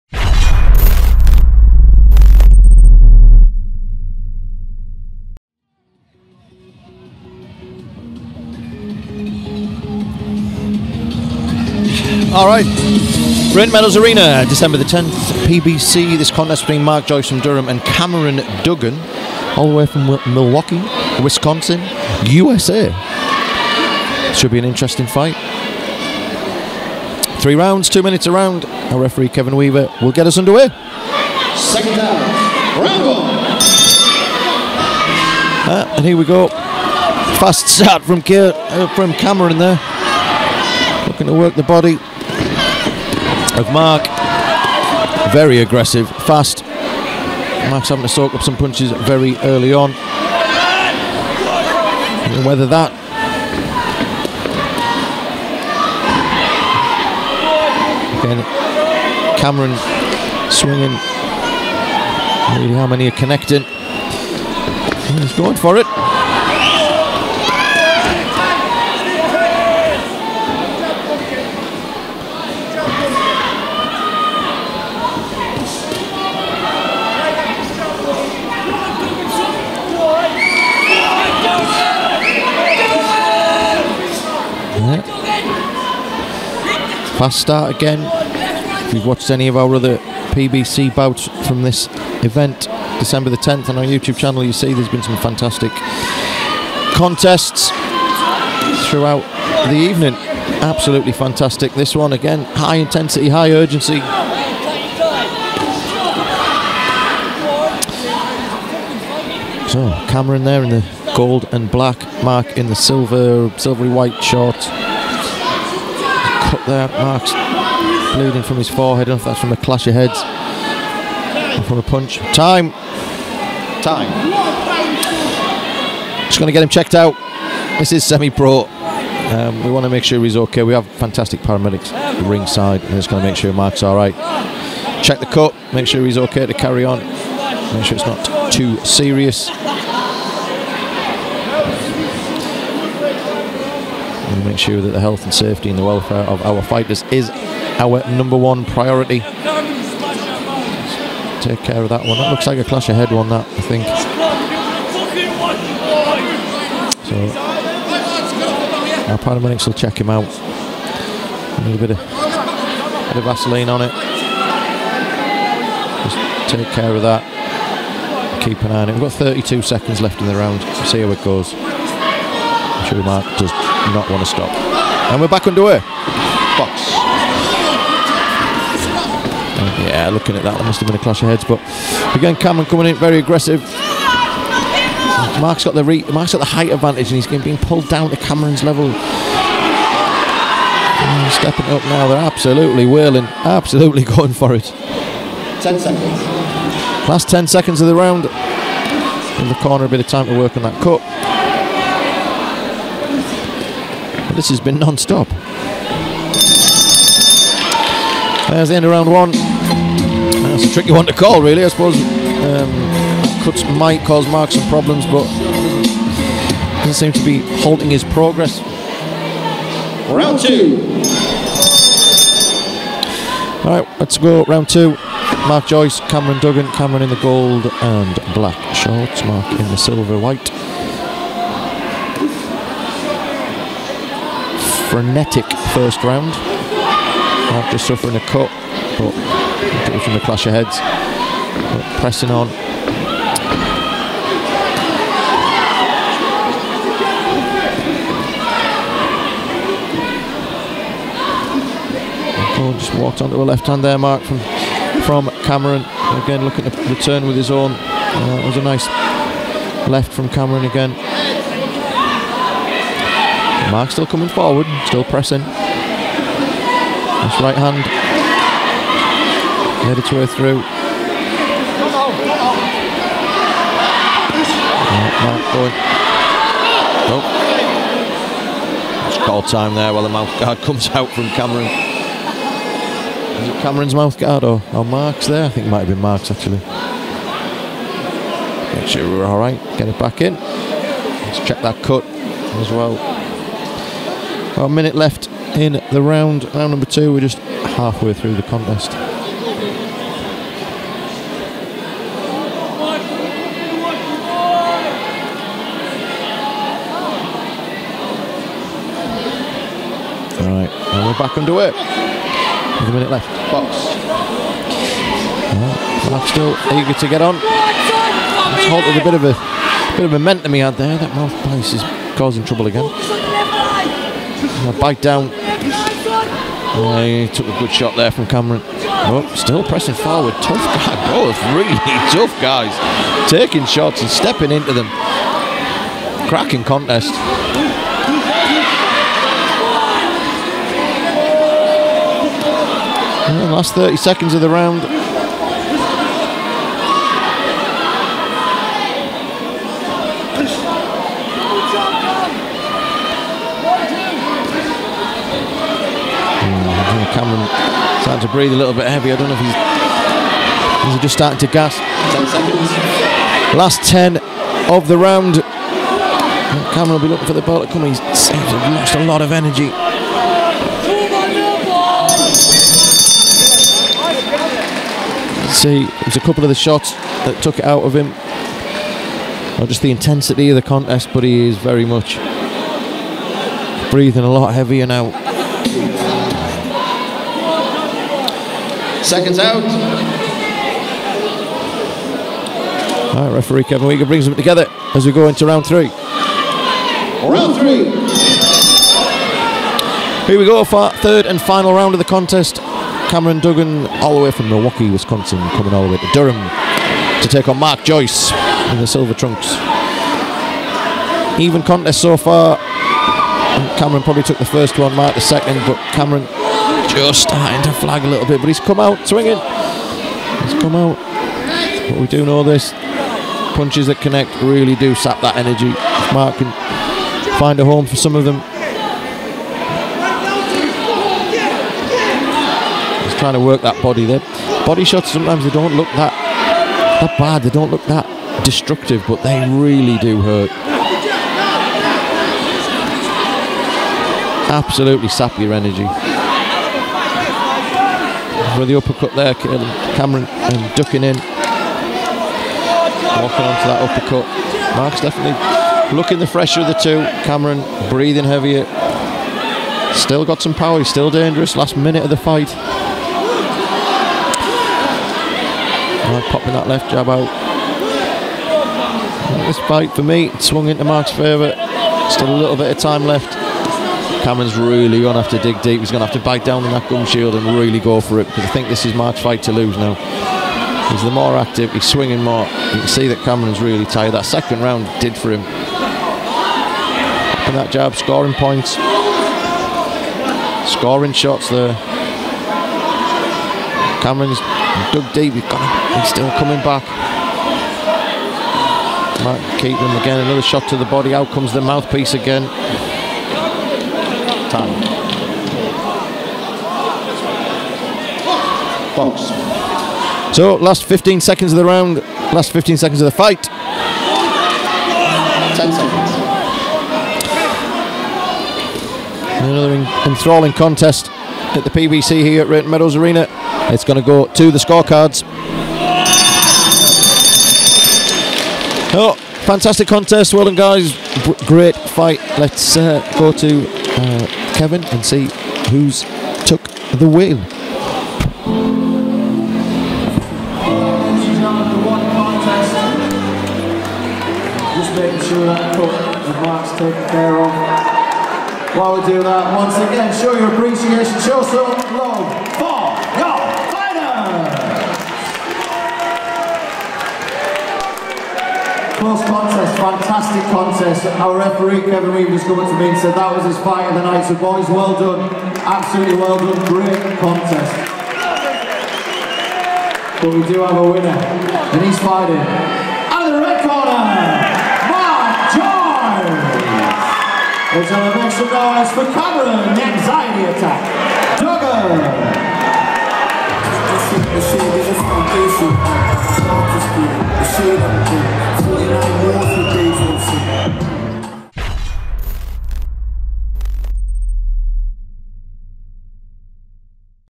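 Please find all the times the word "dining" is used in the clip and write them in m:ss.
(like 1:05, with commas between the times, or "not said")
not said.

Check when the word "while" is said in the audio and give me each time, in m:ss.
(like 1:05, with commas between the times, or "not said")
4:39, 9:08.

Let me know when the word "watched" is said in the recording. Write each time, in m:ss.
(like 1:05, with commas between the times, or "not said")
1:29.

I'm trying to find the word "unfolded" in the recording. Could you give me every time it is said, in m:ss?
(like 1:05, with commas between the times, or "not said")
not said.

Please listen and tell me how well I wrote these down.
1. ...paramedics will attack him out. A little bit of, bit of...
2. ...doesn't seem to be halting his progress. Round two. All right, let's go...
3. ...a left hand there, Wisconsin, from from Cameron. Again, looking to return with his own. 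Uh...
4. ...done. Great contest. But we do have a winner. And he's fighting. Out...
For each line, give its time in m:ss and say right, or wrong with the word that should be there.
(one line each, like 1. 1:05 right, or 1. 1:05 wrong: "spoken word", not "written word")
1. 2:39 wrong: "check", not "attack"
2. 3:36 right
3. 4:13 wrong: "Mark", not "Wisconsin"
4. 9:26 right.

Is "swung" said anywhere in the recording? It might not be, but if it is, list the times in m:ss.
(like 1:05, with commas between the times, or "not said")
7:50.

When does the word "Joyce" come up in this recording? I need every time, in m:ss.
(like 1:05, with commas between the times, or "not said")
0:17, 3:45, 6:47.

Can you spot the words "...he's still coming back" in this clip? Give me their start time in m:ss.
8:15.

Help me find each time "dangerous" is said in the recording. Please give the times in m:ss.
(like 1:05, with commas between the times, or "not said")
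7:41.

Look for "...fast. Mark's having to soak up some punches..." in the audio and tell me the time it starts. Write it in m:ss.
0:46.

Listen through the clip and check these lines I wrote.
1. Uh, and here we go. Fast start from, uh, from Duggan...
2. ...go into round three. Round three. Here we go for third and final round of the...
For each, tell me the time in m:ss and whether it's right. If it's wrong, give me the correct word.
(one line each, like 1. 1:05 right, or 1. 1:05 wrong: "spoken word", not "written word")
1. 0:35 wrong: "Cameron", not "Duggan"
2. 6:35 right.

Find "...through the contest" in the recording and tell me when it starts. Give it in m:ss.
4:58.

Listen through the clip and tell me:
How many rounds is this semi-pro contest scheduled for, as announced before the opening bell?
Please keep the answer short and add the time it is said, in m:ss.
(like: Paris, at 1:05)
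3, at 0:27.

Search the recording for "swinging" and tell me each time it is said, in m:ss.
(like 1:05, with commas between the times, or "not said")
1:00, 6:59, 8:01.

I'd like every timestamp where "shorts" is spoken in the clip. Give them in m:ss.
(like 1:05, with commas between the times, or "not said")
1:54, 3:48.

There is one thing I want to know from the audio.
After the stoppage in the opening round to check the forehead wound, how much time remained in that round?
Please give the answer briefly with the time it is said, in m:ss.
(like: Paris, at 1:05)
32 seconds, at 2:49.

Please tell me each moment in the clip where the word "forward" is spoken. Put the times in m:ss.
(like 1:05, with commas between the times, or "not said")
4:24, 5:29.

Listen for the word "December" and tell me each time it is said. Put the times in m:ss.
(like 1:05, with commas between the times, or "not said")
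0:14, 1:32.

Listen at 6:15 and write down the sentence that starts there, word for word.
See, there's a couple of the shots that took it out of him.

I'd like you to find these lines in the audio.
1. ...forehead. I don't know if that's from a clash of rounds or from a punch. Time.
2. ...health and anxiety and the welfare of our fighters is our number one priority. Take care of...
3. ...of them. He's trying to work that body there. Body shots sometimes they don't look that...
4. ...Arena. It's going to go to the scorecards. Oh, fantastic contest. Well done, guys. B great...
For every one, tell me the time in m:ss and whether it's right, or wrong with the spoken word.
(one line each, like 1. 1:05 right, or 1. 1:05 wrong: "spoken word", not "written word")
1. 1:58 wrong: "heads", not "rounds"
2. 2:24 wrong: "safety", not "anxiety"
3. 7:08 right
4. 8:42 right.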